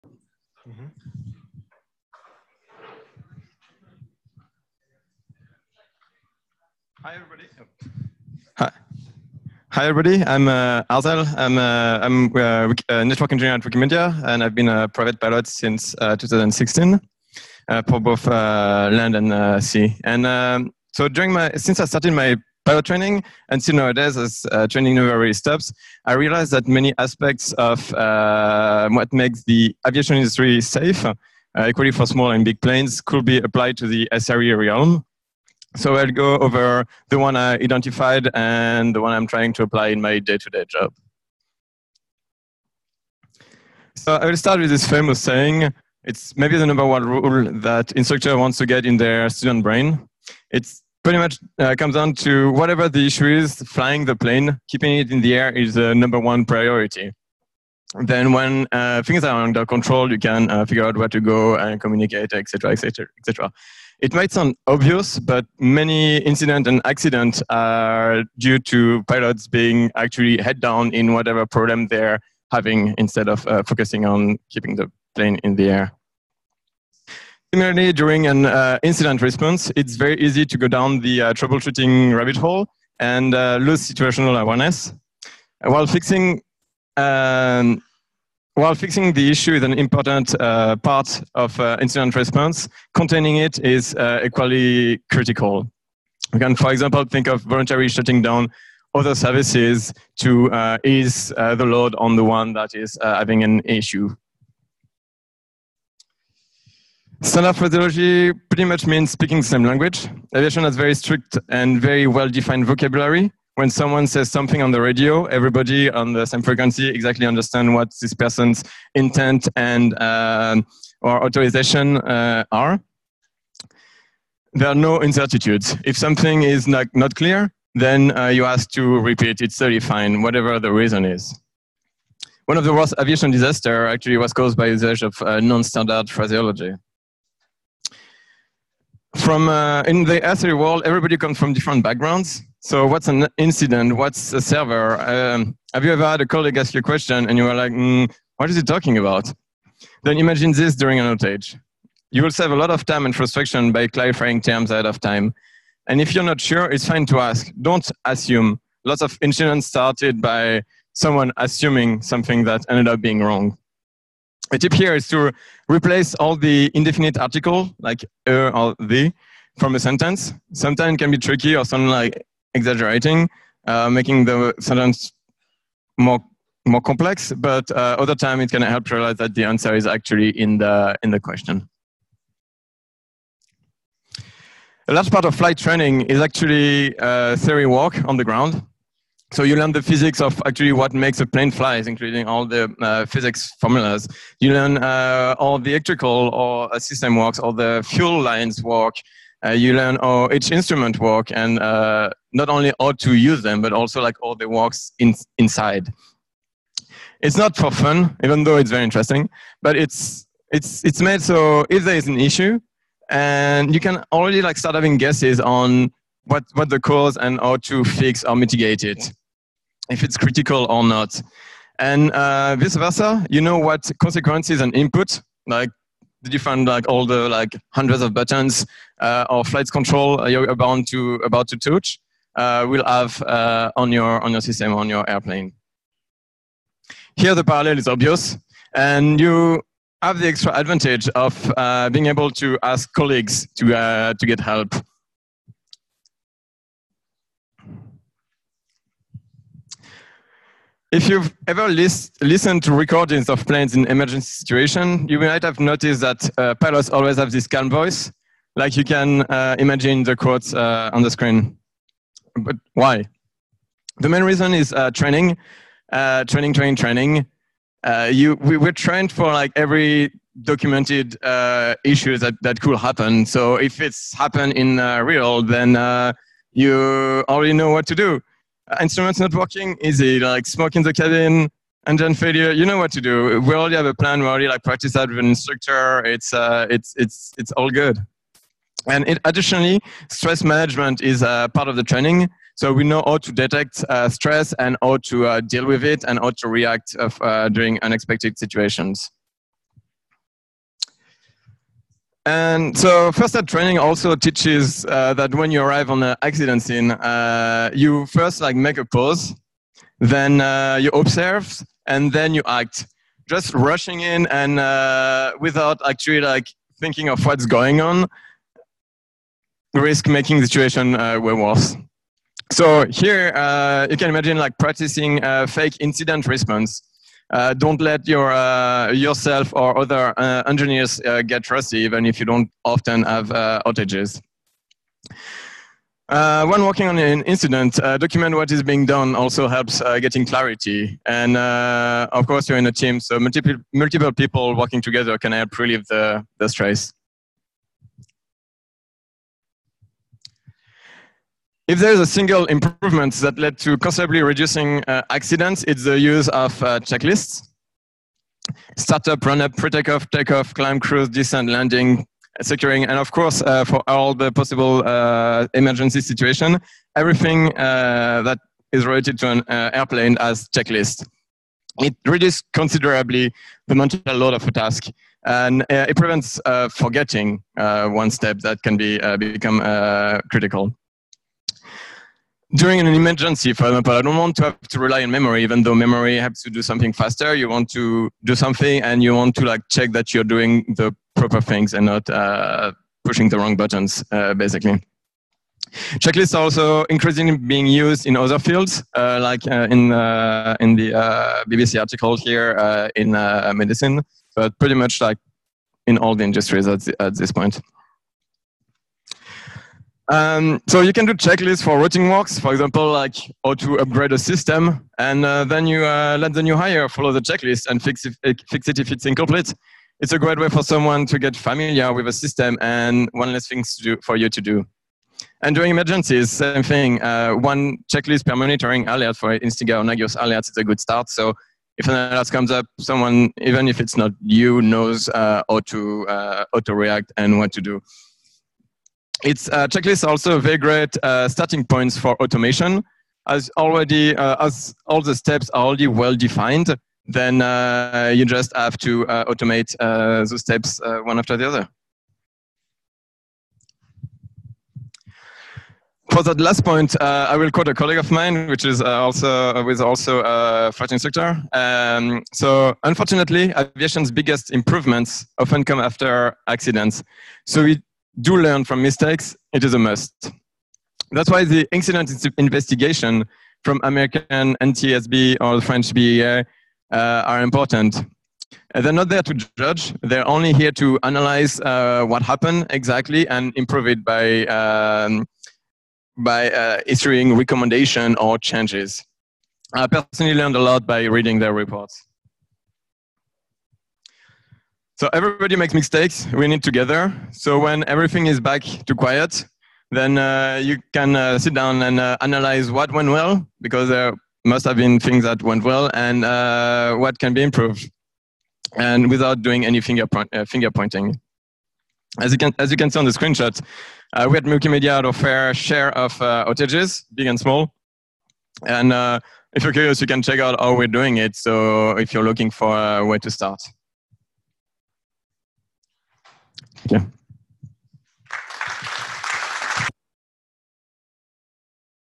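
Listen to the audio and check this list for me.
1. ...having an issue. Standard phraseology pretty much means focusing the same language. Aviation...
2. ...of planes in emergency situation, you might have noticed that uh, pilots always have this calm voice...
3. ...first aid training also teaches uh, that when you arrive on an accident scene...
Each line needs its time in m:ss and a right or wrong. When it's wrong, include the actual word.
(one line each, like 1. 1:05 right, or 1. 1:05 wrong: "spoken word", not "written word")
1. 1:43 wrong: "speaking", not "focusing"
2. 4:13 right
3. 5:03 right.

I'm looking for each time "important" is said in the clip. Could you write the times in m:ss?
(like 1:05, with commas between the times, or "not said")
1:29, 7:57.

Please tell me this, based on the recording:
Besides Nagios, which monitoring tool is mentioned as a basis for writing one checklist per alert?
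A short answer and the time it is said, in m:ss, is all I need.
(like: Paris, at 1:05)
Icinga, at 7:09.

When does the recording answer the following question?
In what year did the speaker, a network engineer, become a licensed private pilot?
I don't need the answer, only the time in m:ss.
0:16.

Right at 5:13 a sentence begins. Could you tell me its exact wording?
Just rushing in and uh, without actually like thinking of what's going on, risk making the situation uh, way worse.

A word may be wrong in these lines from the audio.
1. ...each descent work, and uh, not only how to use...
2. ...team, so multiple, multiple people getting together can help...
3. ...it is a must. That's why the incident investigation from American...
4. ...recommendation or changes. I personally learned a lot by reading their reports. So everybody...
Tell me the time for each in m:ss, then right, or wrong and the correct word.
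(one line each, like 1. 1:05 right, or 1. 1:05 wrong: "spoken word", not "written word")
1. 3:20 wrong: "instrument", not "descent"
2. 5:42 wrong: "working", not "getting"
3. 7:49 right
4. 8:07 right.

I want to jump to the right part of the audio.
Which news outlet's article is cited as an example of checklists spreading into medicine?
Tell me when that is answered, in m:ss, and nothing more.
6:41.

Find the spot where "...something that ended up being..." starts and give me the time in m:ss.
2:42.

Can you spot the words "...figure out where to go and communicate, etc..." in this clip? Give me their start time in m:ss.
1:00.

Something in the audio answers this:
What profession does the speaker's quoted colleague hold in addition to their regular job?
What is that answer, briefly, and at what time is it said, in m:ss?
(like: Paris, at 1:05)
Flight instructor, at 7:40.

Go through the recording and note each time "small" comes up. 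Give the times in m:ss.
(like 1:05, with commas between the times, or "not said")
0:32, 8:37.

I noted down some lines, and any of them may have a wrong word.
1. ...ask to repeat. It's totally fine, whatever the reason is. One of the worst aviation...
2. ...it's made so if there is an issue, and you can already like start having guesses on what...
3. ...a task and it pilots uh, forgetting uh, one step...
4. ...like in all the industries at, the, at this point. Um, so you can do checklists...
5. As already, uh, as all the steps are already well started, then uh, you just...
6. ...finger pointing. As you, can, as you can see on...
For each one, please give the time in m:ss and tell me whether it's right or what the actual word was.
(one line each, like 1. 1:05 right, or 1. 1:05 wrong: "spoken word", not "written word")
1. 2:08 right
2. 3:30 right
3. 6:14 wrong: "prevents", not "pilots"
4. 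6:44 right
5. 7:23 wrong: "defined", not "started"
6. 8:30 right.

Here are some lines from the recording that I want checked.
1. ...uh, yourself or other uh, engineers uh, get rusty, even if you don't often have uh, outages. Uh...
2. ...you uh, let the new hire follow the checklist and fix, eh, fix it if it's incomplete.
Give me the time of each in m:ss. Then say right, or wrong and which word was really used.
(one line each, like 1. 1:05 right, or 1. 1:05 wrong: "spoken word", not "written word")
1. 5:28 right
2. 6:55 right.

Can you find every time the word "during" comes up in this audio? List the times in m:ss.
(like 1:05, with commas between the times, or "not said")
0:21, 1:17, 2:30, 4:57, 6:22, 7:05.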